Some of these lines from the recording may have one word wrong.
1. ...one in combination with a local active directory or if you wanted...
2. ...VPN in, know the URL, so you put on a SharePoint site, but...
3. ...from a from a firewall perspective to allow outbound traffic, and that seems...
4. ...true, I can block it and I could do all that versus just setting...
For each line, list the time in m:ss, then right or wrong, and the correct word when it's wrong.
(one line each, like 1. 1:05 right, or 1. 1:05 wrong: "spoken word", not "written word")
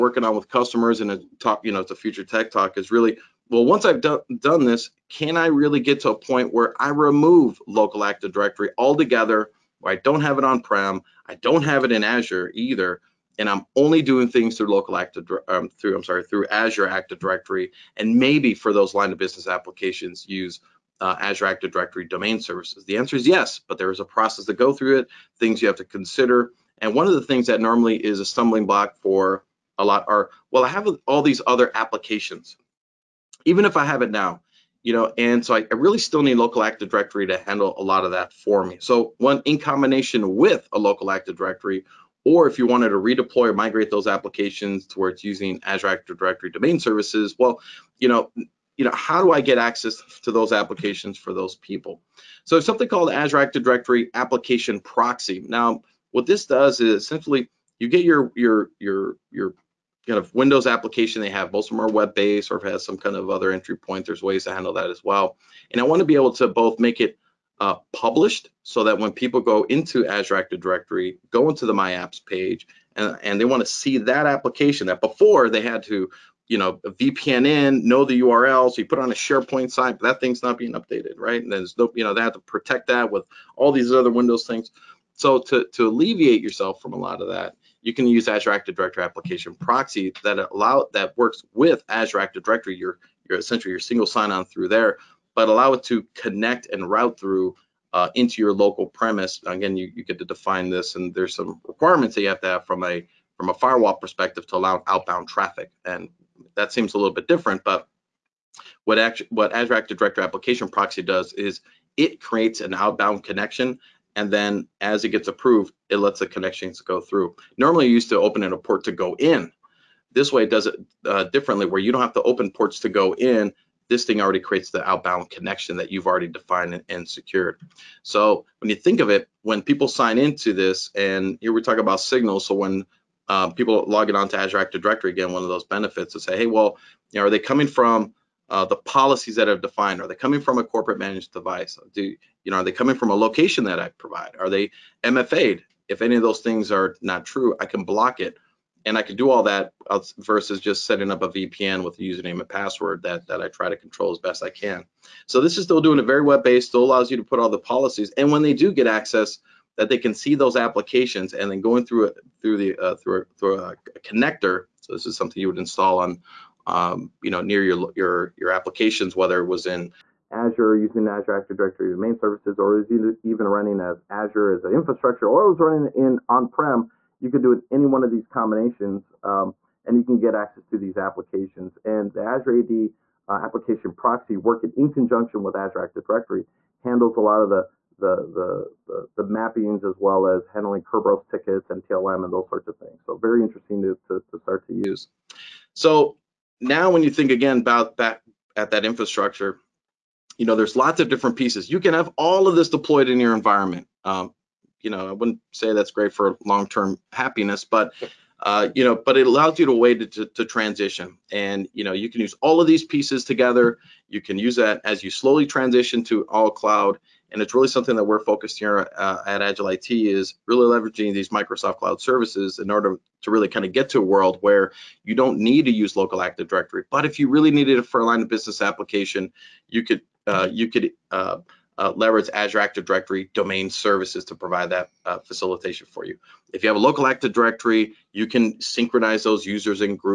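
1. 0:39 right
2. 1:16 right
3. 1:42 right
4. 2:27 right.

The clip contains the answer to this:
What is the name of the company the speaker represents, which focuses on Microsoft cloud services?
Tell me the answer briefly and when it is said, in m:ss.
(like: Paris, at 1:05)
Agile IT, at 3:39.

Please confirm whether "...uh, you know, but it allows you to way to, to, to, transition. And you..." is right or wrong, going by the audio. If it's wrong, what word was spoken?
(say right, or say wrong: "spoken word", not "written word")
right.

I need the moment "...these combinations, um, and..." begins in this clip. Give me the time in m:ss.
2:58.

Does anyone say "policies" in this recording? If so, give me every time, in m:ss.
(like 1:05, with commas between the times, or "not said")
2:18, 2:37.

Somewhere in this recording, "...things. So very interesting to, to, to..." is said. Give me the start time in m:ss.
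3:12.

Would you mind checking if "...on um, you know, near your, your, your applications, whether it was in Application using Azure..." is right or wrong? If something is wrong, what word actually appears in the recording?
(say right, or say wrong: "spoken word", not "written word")
wrong: "Azure", not "Application".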